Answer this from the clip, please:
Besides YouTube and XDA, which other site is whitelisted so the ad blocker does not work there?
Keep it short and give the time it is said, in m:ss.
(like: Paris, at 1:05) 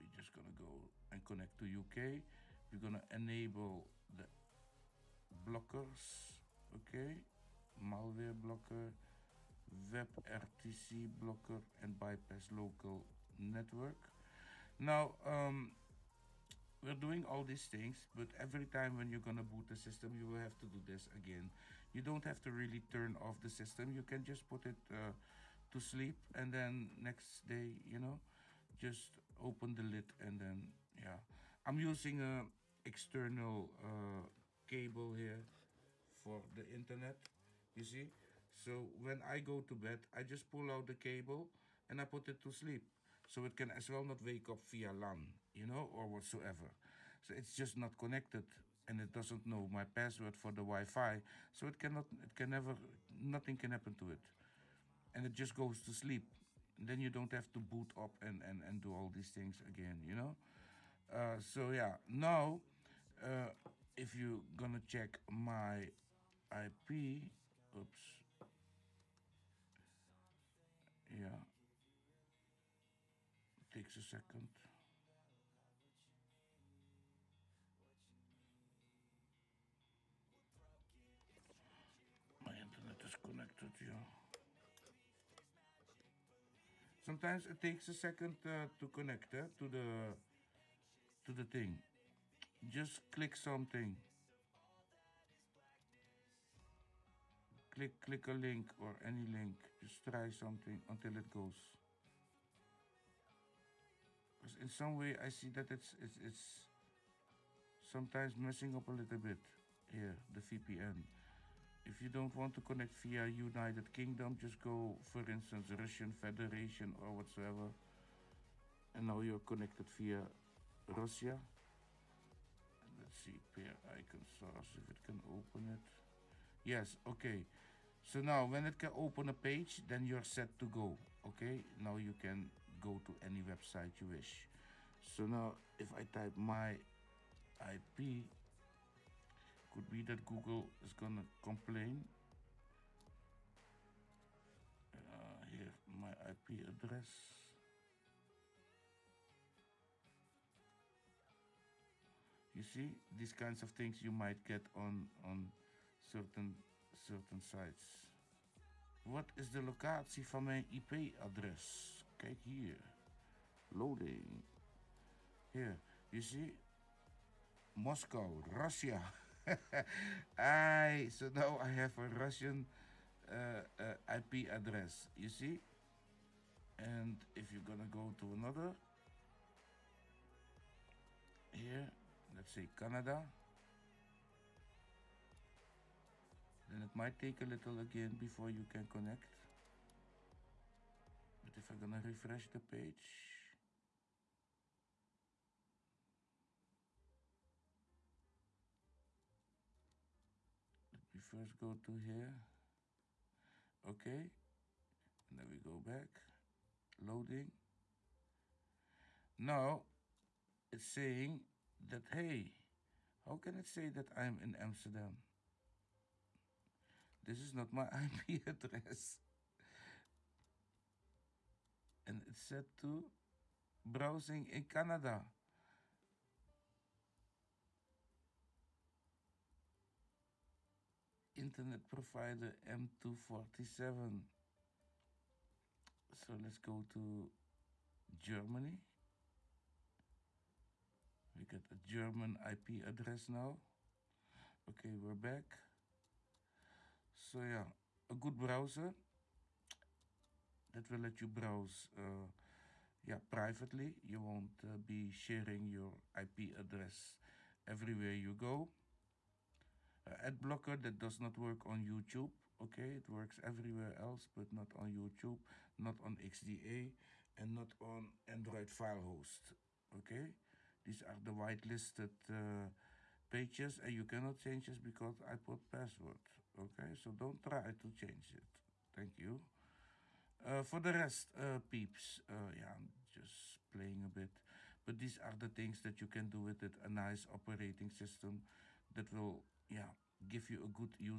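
Android File Host, at 4:28.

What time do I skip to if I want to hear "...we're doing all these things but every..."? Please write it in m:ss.
0:16.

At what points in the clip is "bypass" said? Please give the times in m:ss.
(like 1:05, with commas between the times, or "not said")
0:11.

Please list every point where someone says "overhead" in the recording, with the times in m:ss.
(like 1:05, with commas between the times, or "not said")
not said.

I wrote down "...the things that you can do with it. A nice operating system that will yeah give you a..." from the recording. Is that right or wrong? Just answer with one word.
right.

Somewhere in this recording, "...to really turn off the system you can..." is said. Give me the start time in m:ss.
0:22.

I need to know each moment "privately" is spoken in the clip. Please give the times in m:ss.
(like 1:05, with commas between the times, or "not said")
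4:13.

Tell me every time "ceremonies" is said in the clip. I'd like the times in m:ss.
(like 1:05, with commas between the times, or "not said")
not said.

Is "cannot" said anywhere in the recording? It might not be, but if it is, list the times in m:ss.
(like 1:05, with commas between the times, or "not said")
0:51, 4:34.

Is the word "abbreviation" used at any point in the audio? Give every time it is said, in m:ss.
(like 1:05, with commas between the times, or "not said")
not said.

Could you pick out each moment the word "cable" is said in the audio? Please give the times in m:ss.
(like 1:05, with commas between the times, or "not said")
0:34, 0:40.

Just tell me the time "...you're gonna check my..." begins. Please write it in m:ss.
1:04.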